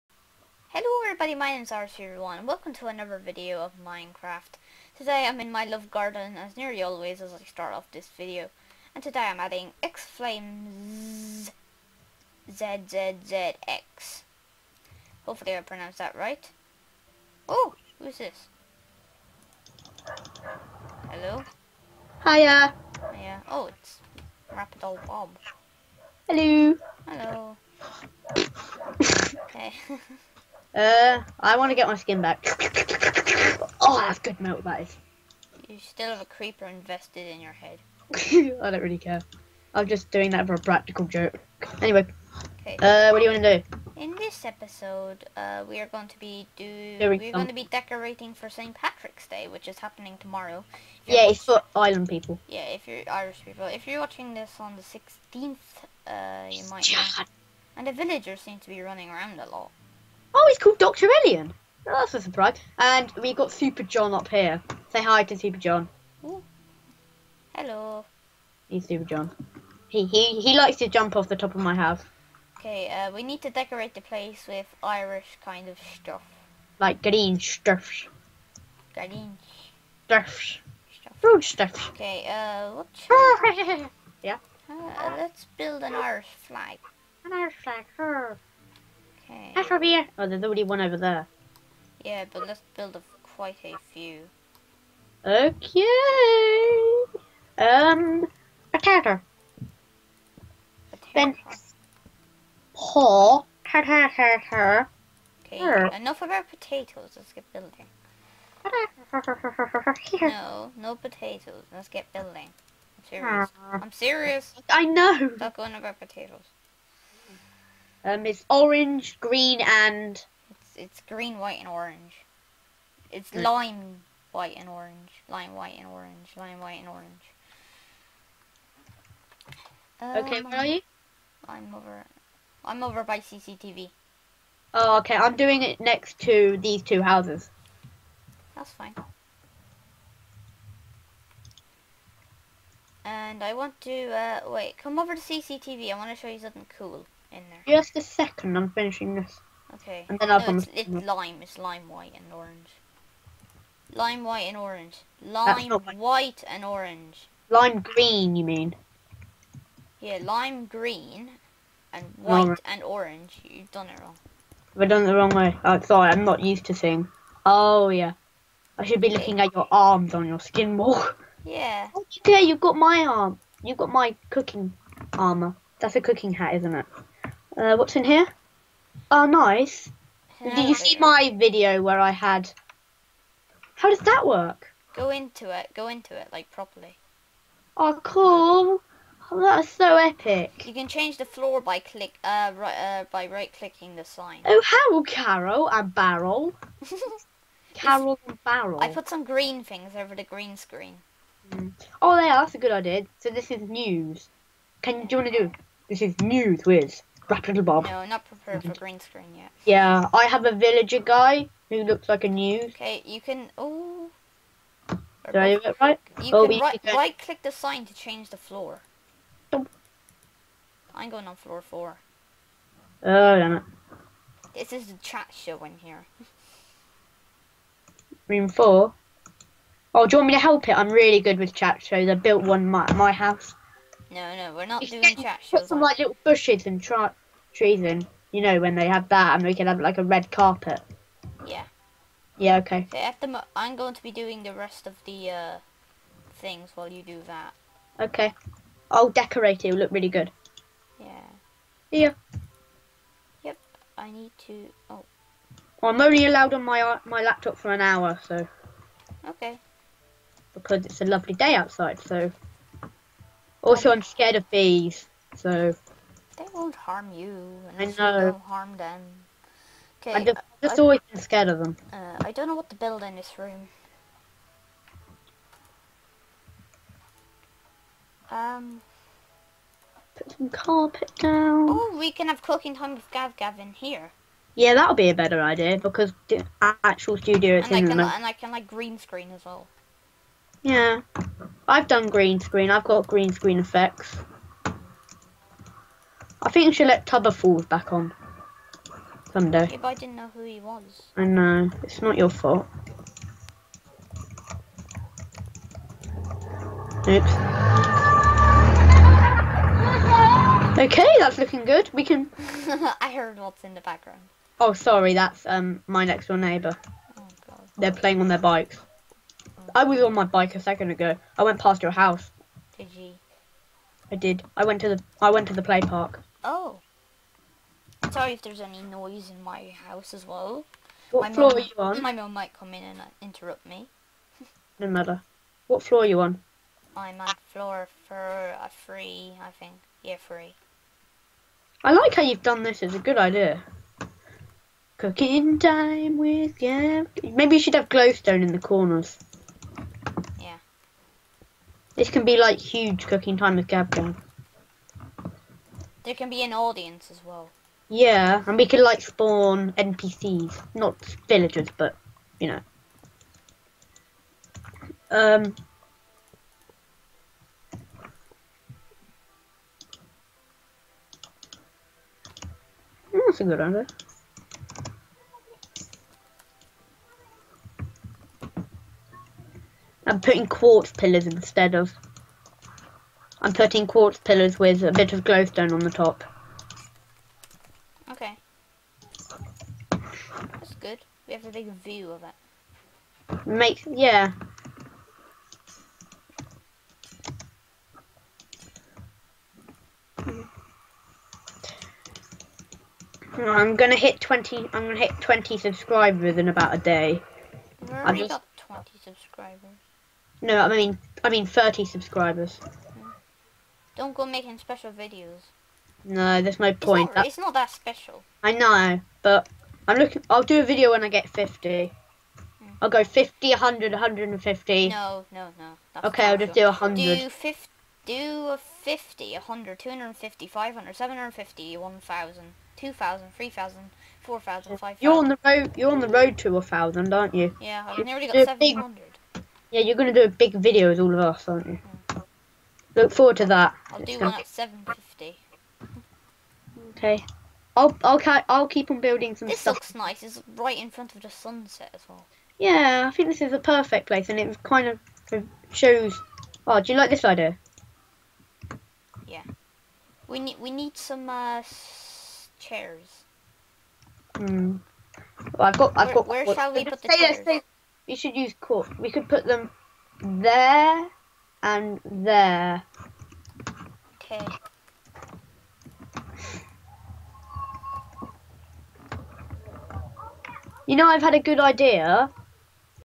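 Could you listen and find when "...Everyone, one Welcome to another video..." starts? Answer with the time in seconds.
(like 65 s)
1 s.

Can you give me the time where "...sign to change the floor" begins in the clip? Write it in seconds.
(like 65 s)
217 s.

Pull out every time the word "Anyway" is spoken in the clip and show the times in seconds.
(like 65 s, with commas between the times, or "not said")
41 s.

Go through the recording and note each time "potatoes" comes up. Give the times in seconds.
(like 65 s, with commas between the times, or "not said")
106 s, 110 s, 115 s.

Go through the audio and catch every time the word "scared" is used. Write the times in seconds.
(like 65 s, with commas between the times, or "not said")
264 s, 271 s.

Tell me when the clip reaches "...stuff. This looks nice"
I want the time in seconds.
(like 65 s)
449 s.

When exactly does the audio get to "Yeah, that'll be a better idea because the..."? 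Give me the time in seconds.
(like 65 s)
284 s.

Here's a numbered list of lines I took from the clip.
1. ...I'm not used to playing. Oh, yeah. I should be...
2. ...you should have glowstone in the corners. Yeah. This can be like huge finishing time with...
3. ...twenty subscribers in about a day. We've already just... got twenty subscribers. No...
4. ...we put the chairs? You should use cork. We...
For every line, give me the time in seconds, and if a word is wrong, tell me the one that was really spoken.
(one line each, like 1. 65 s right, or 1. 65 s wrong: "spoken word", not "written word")
1. 166 s wrong: "seeing", not "playing"
2. 347 s wrong: "cooking", not "finishing"
3. 405 s right
4. 466 s right.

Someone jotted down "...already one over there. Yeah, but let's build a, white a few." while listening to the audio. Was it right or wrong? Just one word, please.
wrong.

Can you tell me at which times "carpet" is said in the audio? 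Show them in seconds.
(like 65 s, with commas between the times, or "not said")
240 s, 280 s.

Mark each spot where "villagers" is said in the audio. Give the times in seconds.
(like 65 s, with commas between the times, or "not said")
57 s, 210 s, 361 s.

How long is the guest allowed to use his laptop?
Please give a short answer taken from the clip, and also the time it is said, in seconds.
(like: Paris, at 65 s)
an hour, at 257 s.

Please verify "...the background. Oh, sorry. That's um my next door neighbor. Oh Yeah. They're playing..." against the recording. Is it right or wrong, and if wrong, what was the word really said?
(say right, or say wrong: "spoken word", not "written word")
wrong: "God", not "Yeah".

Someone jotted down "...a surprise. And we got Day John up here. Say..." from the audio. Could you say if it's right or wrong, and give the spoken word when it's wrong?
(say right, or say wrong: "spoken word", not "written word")
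wrong: "Super", not "Day".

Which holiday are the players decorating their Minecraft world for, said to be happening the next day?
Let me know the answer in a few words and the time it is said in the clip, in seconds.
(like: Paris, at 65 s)
St. Patrick's Day, at 48 s.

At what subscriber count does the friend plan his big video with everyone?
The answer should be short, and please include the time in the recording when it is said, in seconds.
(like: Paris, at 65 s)
750, at 444 s.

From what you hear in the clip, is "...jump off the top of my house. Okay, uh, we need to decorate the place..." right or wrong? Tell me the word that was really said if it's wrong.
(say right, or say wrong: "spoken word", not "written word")
right.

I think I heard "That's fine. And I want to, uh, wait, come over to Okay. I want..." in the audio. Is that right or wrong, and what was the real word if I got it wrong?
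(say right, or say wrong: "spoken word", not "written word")
wrong: "CCTV", not "Okay".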